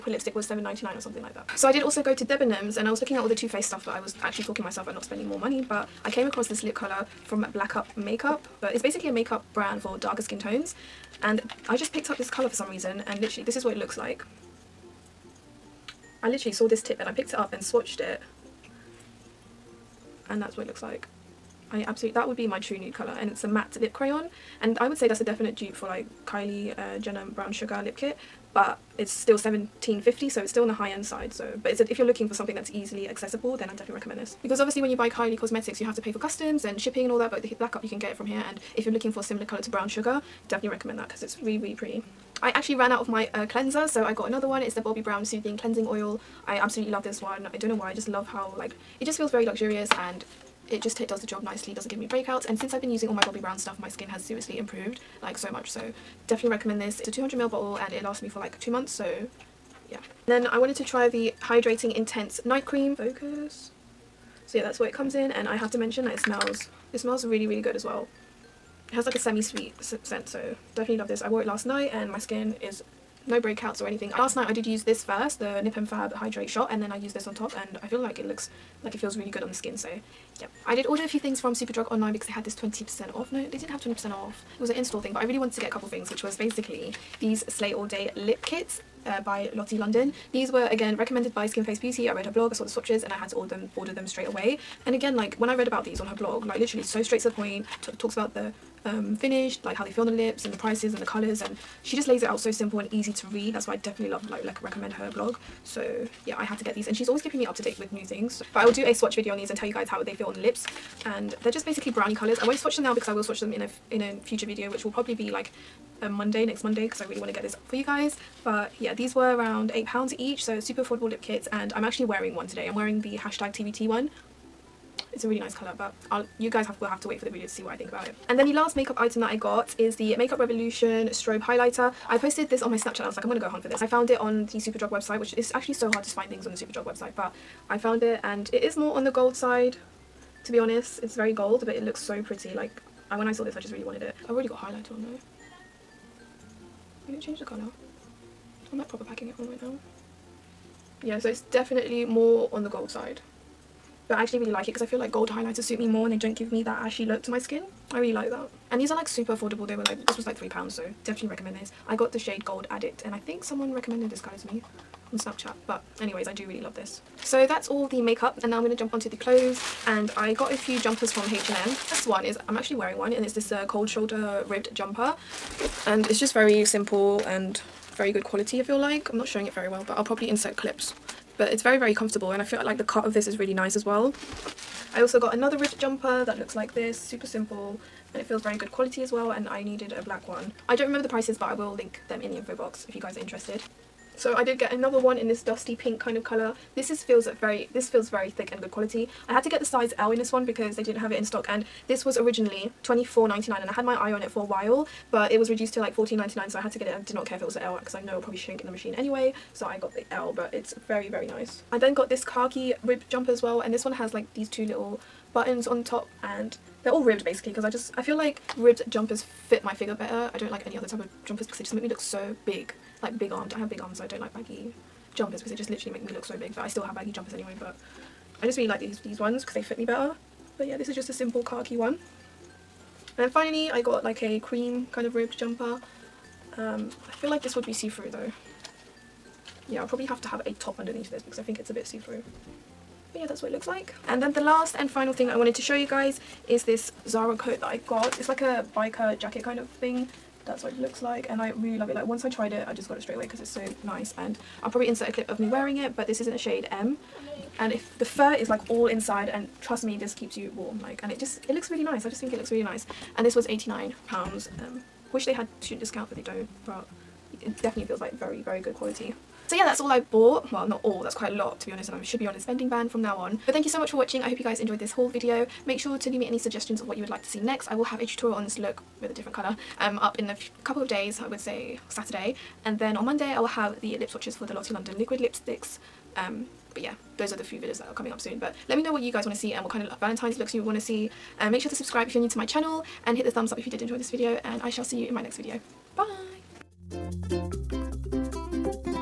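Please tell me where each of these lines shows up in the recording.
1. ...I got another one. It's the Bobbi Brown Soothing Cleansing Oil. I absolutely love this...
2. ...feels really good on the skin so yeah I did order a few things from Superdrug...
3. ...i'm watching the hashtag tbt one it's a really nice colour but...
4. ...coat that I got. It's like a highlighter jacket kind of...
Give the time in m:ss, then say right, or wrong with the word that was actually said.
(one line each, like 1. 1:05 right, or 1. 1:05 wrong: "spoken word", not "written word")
1. 0:44 right
2. 1:18 right
3. 2:02 wrong: "wearing", not "watching"
4. 4:07 wrong: "biker", not "highlighter".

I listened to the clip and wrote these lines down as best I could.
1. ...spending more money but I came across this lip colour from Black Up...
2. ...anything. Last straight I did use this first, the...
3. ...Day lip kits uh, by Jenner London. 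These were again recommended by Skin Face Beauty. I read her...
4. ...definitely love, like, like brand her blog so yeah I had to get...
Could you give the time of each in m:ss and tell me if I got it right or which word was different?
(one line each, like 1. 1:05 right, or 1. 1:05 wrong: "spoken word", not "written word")
1. 0:05 right
2. 1:13 wrong: "night", not "straight"
3. 1:27 wrong: "Lottie", not "Jenner"
4. 1:43 wrong: "recommend", not "brand".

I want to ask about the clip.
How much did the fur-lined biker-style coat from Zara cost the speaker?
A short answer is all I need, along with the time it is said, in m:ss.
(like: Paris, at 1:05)
89 pounds, at 4:23.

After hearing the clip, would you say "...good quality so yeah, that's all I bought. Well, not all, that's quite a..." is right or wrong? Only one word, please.
right.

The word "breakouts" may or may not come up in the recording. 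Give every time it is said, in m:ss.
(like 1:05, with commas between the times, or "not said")
0:52, 1:13.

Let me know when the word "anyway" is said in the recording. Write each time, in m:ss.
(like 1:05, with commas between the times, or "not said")
2:46, 3:28, 3:47.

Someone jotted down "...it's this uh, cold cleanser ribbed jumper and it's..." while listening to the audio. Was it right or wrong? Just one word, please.
wrong.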